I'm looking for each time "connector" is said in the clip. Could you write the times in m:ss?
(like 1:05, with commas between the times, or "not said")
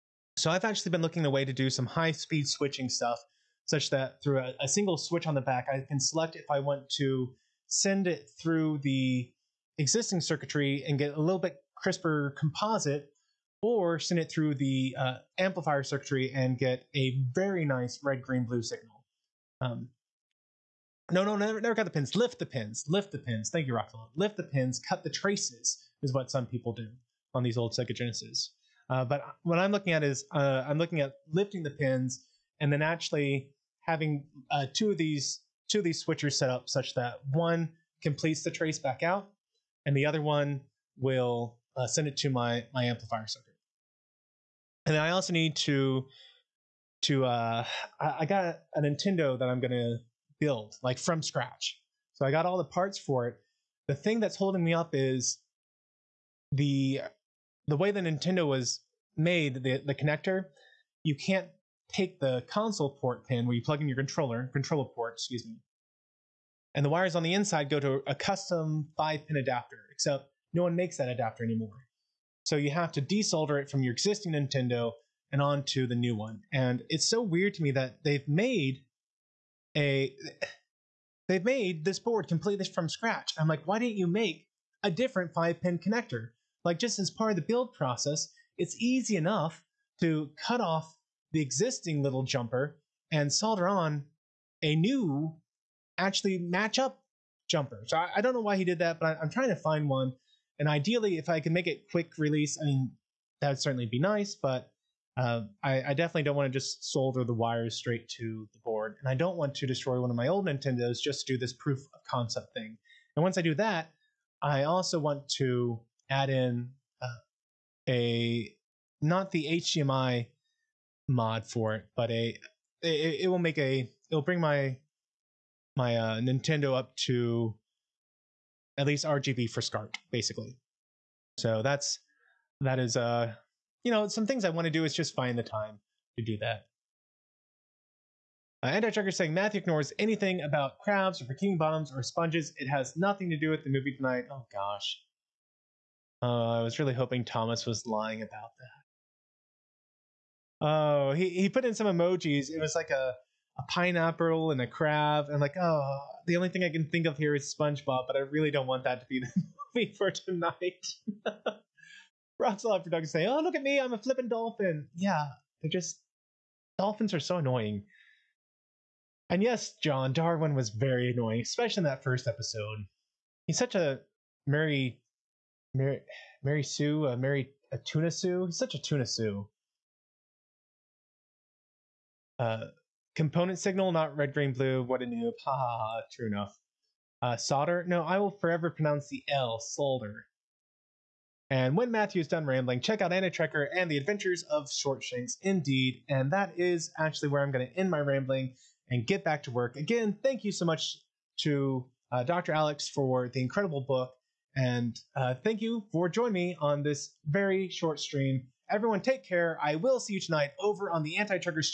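0:59, 1:25.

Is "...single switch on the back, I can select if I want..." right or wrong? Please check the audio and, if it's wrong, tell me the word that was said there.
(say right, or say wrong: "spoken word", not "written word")
right.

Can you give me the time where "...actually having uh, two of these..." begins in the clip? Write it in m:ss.
0:32.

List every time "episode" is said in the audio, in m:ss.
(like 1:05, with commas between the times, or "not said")
2:52.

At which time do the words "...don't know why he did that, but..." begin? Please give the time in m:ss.
1:38.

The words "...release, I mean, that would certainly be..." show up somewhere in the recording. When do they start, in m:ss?
1:42.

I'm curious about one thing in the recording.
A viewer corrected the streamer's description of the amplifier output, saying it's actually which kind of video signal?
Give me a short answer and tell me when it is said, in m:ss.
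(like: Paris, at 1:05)
Component, at 3:03.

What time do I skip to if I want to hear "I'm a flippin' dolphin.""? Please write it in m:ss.
2:43.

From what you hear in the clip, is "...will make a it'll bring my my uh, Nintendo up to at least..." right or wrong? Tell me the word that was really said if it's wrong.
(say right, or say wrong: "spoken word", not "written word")
right.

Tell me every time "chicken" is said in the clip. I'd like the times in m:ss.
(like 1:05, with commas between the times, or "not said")
not said.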